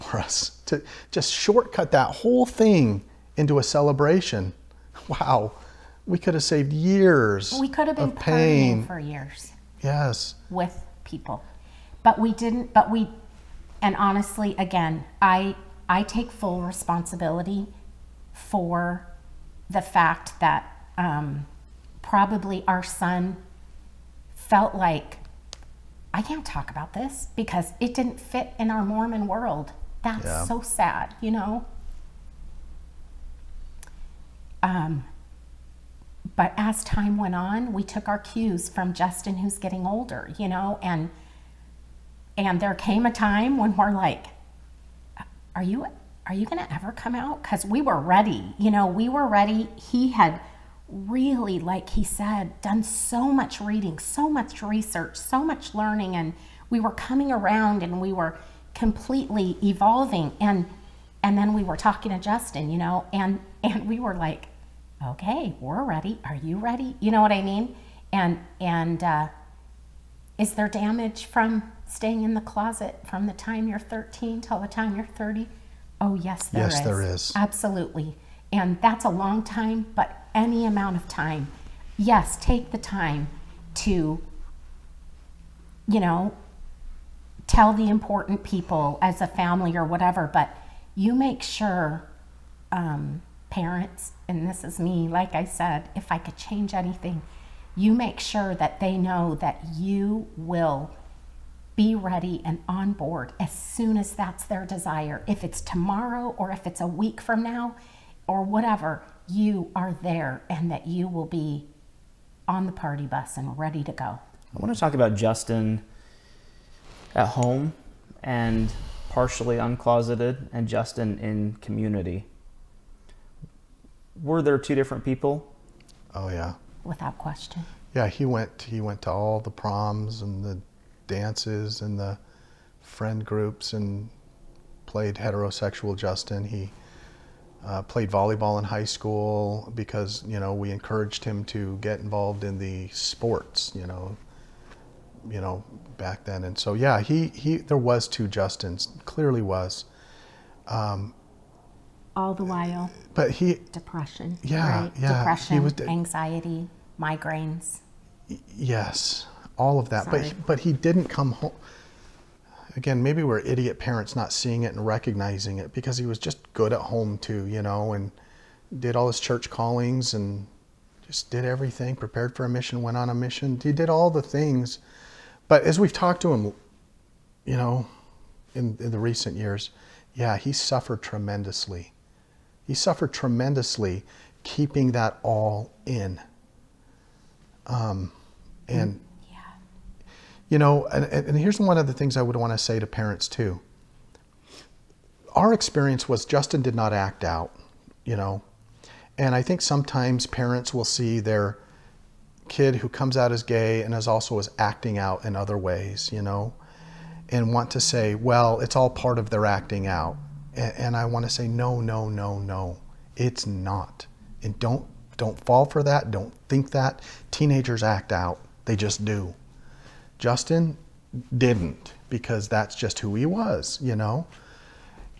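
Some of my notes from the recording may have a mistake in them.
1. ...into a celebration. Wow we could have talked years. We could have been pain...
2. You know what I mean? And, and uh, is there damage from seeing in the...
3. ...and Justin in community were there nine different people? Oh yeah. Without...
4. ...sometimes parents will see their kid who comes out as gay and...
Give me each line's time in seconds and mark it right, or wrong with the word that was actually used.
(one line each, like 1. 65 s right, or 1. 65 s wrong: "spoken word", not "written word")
1. 3 s wrong: "saved", not "talked"
2. 66 s wrong: "staying", not "seeing"
3. 120 s wrong: "two", not "nine"
4. 199 s right.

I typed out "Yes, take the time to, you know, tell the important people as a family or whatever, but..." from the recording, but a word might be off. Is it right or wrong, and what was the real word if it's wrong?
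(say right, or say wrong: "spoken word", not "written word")
right.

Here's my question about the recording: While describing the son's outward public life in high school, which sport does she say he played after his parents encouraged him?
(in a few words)
volleyball.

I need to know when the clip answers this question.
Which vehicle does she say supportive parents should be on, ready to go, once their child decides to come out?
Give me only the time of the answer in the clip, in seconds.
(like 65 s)
112 s.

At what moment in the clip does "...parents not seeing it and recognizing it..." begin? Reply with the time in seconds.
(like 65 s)
163 s.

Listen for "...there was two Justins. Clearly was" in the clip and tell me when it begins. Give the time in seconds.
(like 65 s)
147 s.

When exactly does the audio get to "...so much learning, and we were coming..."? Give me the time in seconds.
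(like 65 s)
55 s.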